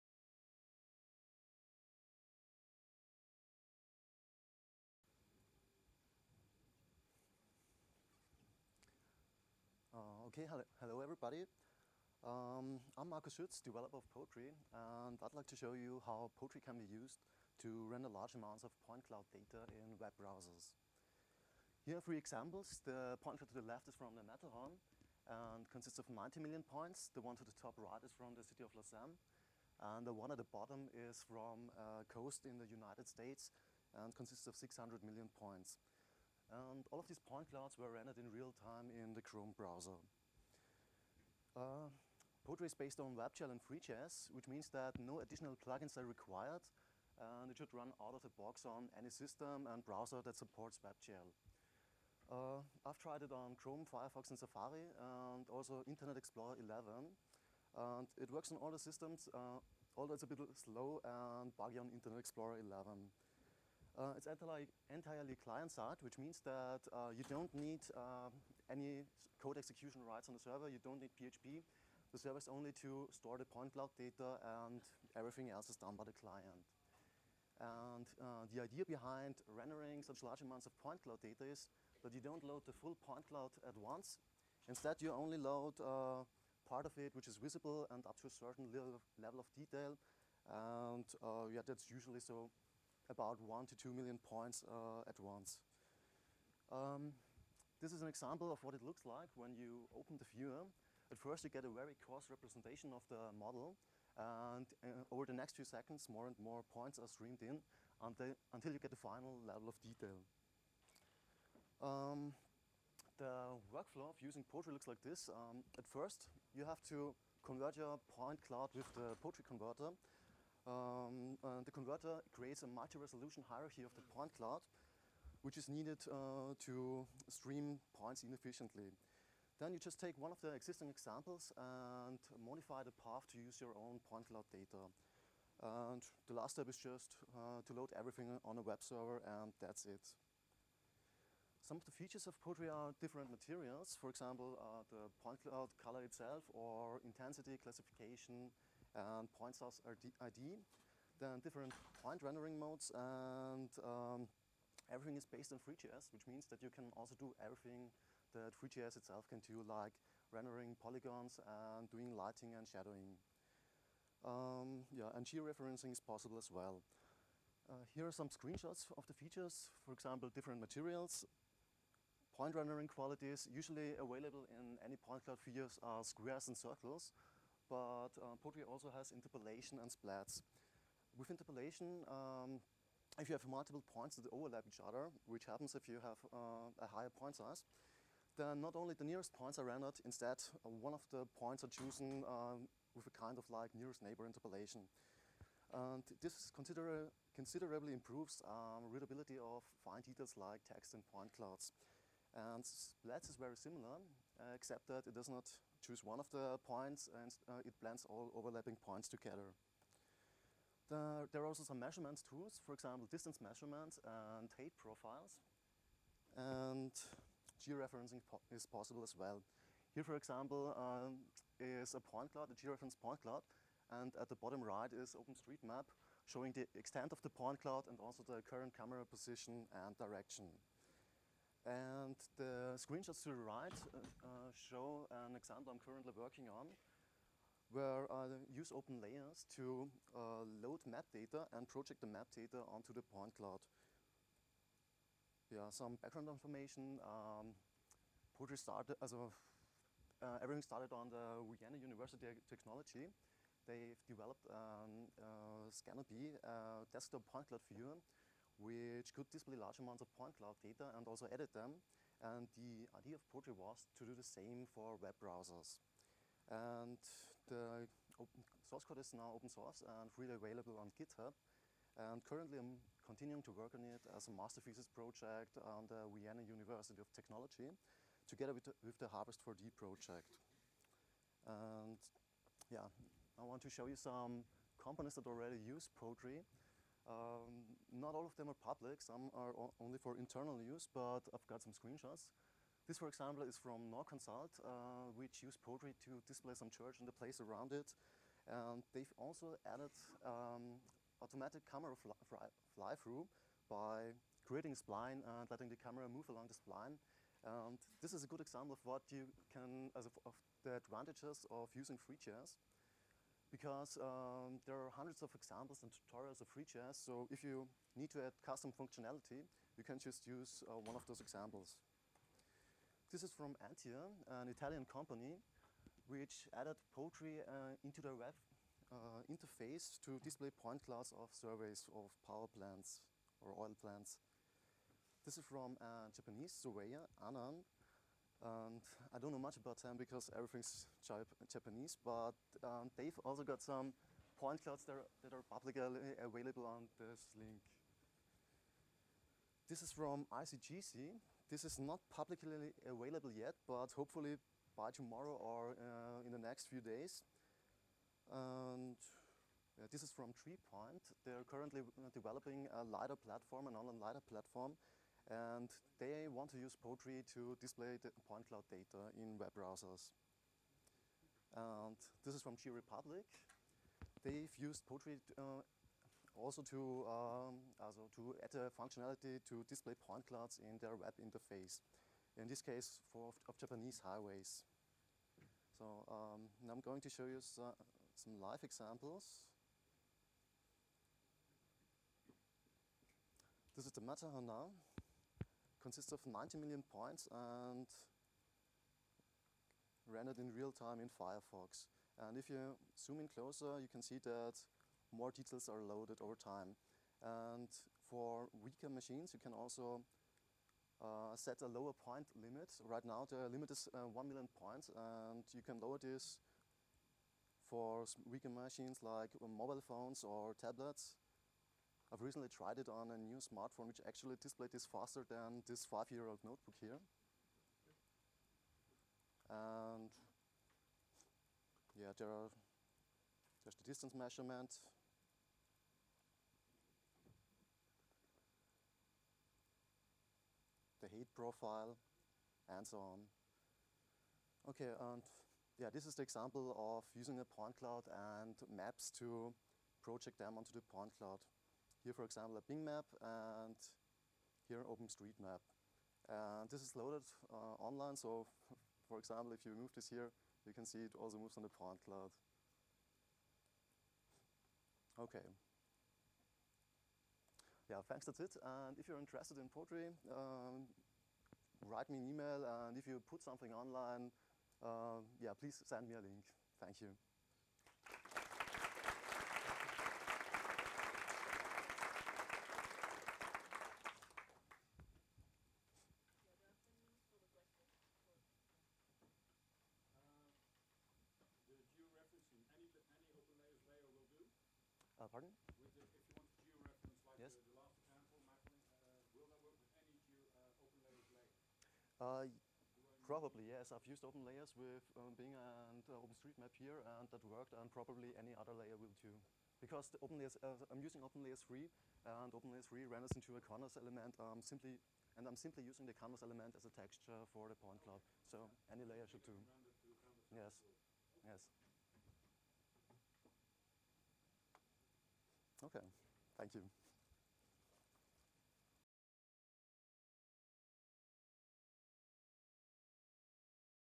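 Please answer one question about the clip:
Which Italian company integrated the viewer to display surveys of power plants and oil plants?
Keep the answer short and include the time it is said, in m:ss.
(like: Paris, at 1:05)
Antia, at 5:23.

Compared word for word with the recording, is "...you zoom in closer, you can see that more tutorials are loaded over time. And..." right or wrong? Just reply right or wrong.
wrong.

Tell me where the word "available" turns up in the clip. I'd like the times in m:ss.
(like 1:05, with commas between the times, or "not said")
2:53, 4:30, 5:46, 5:52.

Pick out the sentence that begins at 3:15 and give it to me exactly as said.
And this consider considerably improves um, readability of fine details like text and point clouds.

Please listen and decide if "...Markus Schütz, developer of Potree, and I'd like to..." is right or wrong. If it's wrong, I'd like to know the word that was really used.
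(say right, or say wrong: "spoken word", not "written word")
right.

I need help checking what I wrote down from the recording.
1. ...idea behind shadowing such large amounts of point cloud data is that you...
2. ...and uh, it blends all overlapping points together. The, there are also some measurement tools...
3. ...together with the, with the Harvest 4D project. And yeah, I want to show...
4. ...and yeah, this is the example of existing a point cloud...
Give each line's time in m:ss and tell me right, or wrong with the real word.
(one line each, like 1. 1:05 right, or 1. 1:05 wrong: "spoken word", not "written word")
1. 1:18 wrong: "rendering", not "shadowing"
2. 3:27 right
3. 4:38 right
4. 7:25 wrong: "using", not "existing".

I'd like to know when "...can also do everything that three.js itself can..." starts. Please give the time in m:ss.
2:36.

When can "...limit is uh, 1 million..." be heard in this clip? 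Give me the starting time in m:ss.
6:53.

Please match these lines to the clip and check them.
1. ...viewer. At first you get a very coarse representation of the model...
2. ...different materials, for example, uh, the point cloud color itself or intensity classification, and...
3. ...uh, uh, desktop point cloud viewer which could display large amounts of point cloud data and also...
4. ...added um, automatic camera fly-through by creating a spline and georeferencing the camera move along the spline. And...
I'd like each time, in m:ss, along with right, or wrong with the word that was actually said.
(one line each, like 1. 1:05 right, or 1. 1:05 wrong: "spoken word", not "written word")
1. 1:40 right
2. 2:22 right
3. 4:15 right
4. 4:59 wrong: "letting", not "georeferencing".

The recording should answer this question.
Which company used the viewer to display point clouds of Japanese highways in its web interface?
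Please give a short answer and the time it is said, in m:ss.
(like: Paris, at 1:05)
Georepublic, at 6:12.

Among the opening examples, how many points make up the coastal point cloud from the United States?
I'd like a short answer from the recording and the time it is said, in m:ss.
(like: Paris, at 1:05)
600 million, at 0:34.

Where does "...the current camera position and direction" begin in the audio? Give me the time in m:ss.
3:48.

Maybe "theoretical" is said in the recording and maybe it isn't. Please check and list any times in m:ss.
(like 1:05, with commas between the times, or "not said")
not said.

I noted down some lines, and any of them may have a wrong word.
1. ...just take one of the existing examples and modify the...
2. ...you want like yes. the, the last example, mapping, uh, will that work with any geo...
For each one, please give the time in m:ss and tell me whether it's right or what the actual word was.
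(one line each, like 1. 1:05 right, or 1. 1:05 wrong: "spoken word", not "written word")
1. 2:09 right
2. 8:17 right.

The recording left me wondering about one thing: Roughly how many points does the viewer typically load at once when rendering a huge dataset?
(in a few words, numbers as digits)
1 to 2 million.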